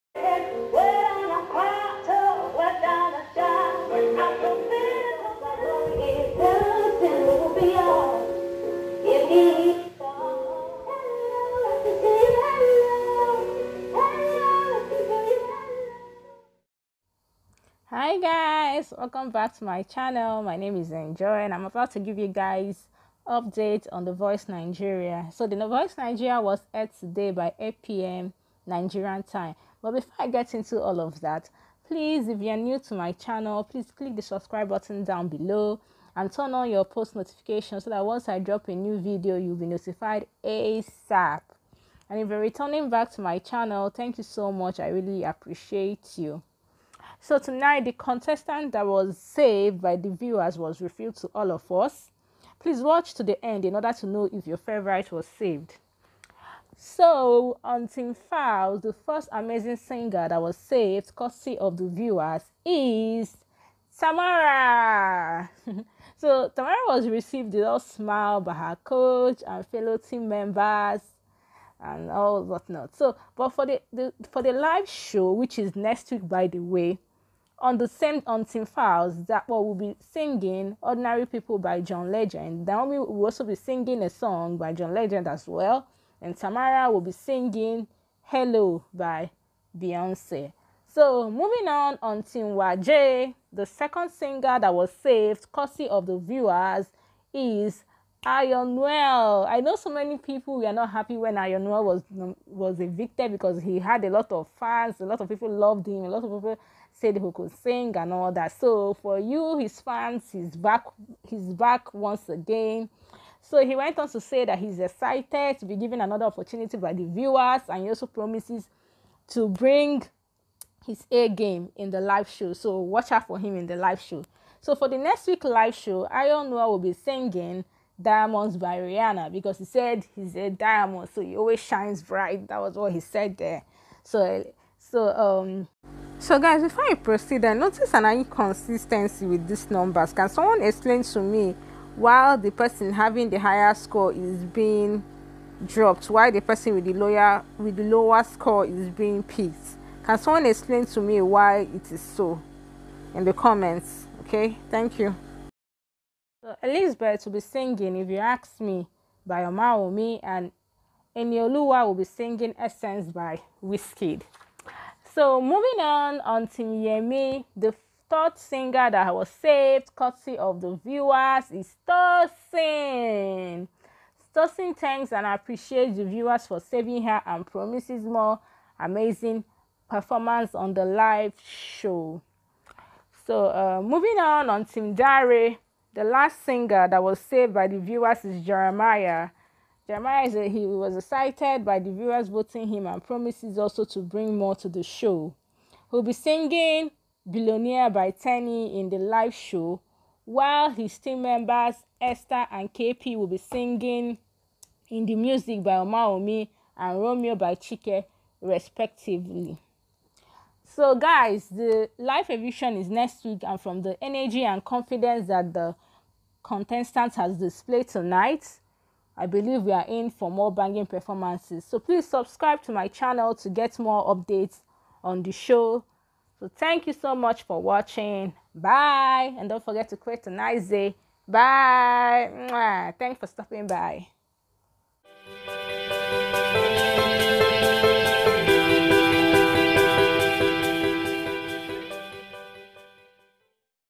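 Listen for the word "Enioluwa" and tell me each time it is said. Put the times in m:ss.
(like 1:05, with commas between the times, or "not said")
2:41.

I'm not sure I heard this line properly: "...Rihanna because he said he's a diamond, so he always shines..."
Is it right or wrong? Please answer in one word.
right.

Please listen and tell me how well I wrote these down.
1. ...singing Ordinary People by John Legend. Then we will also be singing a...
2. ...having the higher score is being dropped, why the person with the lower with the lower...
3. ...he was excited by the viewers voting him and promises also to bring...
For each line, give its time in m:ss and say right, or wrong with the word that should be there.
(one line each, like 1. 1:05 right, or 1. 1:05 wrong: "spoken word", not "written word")
1. 1:20 right
2. 2:22 right
3. 3:10 right.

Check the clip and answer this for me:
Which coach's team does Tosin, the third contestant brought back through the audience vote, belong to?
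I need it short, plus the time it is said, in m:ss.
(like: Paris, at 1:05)
Yemi, at 2:46.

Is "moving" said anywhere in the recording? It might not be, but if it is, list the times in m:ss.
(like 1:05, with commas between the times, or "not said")
1:31, 2:45, 3:03.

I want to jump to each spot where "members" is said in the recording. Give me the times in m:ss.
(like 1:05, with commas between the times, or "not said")
1:10, 3:21.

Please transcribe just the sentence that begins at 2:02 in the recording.
So watch out for him in the live show.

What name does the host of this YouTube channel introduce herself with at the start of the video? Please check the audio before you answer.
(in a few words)
Njoy.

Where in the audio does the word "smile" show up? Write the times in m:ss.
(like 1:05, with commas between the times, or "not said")
1:07.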